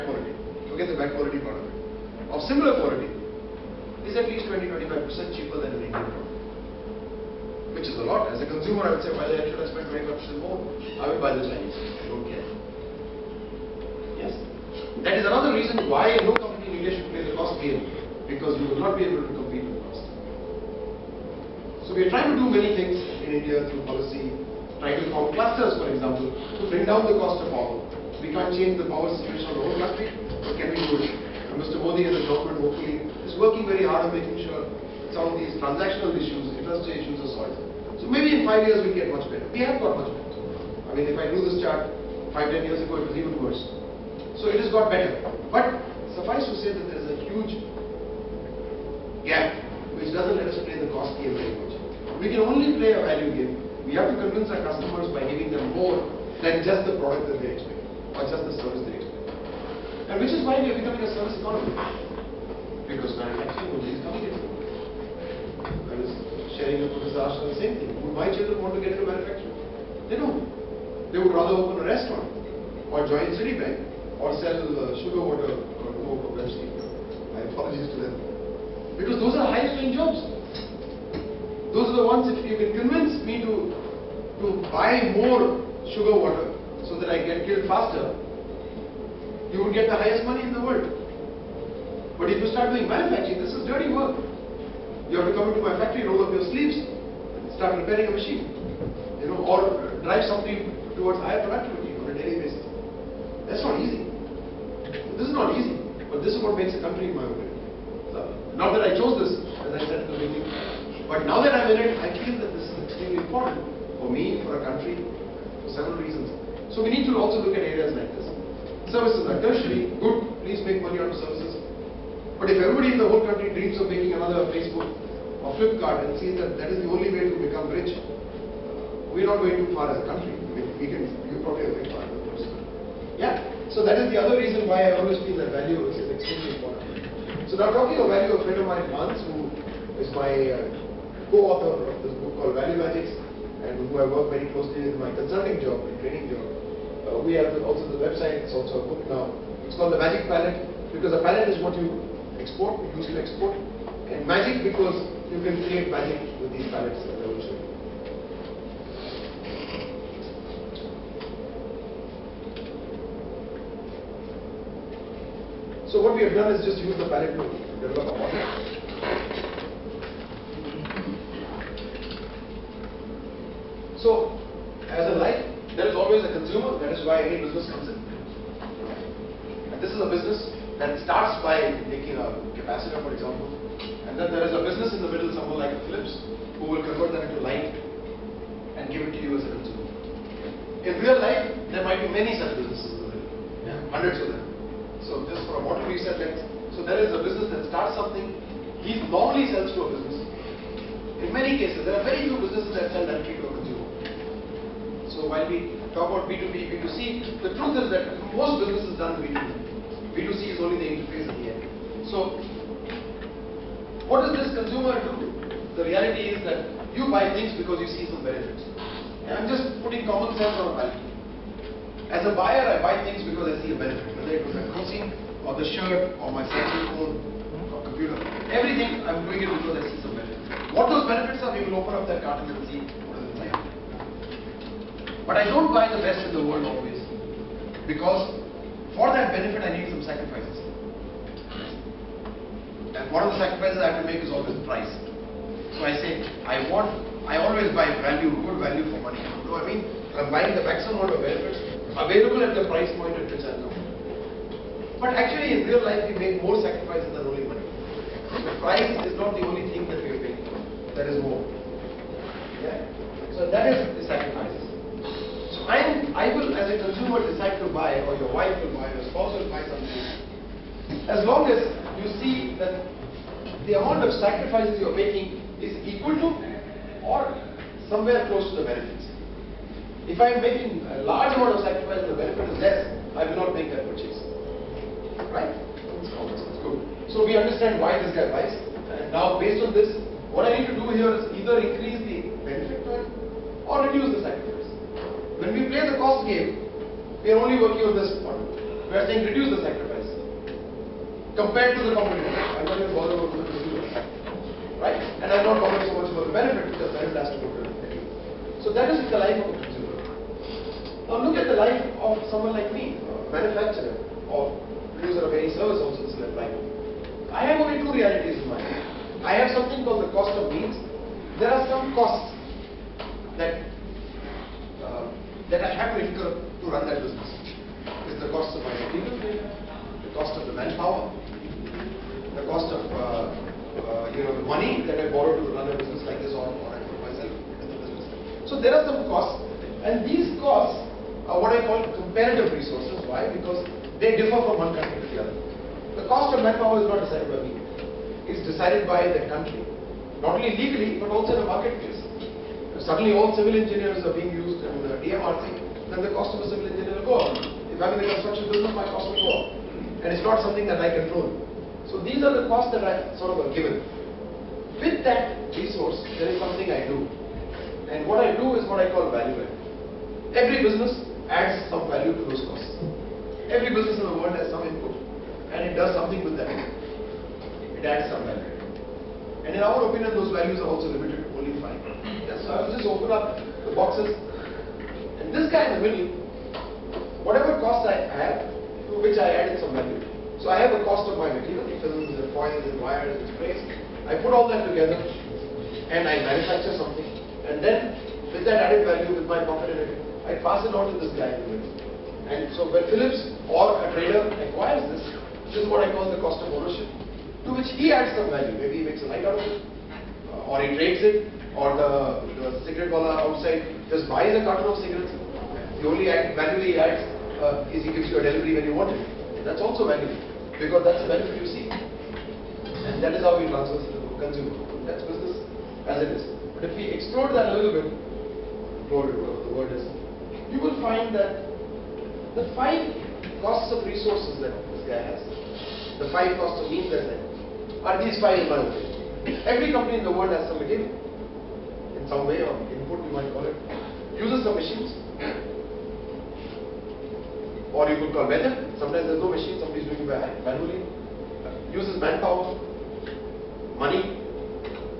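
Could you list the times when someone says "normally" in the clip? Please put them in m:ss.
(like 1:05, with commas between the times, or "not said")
3:19.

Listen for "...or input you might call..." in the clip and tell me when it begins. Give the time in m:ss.
7:22.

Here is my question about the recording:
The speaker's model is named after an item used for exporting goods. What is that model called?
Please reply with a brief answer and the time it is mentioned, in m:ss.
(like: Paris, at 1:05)
The Magic Pallet, at 2:29.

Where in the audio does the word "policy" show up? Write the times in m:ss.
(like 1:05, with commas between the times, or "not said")
0:23.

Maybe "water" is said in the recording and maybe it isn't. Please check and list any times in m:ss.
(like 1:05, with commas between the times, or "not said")
1:15, 1:26.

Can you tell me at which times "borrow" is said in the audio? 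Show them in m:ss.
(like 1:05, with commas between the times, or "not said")
5:35.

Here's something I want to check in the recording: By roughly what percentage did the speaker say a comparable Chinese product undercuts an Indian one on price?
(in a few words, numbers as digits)
20-25%.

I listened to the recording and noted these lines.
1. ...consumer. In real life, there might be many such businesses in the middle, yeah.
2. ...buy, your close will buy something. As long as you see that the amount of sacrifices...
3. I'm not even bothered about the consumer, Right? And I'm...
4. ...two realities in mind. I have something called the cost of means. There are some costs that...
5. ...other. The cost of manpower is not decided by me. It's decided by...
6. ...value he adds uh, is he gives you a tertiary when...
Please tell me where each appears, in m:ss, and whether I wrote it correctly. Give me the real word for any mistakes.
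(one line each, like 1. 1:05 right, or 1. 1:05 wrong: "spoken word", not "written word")
1. 3:09 right
2. 4:28 wrong: "spouse", not "close"
3. 5:02 right
4. 5:17 right
5. 5:45 right
6. 6:56 wrong: "delivery", not "tertiary".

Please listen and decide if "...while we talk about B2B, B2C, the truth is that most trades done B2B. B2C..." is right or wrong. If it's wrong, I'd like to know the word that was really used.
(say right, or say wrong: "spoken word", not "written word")
wrong: "businesses", not "trades".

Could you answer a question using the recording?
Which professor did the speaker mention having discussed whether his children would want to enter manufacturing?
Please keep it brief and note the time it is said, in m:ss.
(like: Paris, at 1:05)
Professor Ashton, at 1:06.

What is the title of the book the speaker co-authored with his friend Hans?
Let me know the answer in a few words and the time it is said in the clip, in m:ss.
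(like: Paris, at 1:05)
Value Magics, at 2:22.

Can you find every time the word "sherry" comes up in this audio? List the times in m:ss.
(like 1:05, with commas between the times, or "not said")
not said.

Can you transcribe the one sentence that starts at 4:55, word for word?
When we play the cost game, we are only working on this one.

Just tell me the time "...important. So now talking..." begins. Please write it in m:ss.
2:16.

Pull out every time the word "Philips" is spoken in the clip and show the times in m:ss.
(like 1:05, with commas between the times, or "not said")
3:05, 6:42.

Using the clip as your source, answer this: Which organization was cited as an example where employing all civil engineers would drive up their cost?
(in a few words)
DMRC.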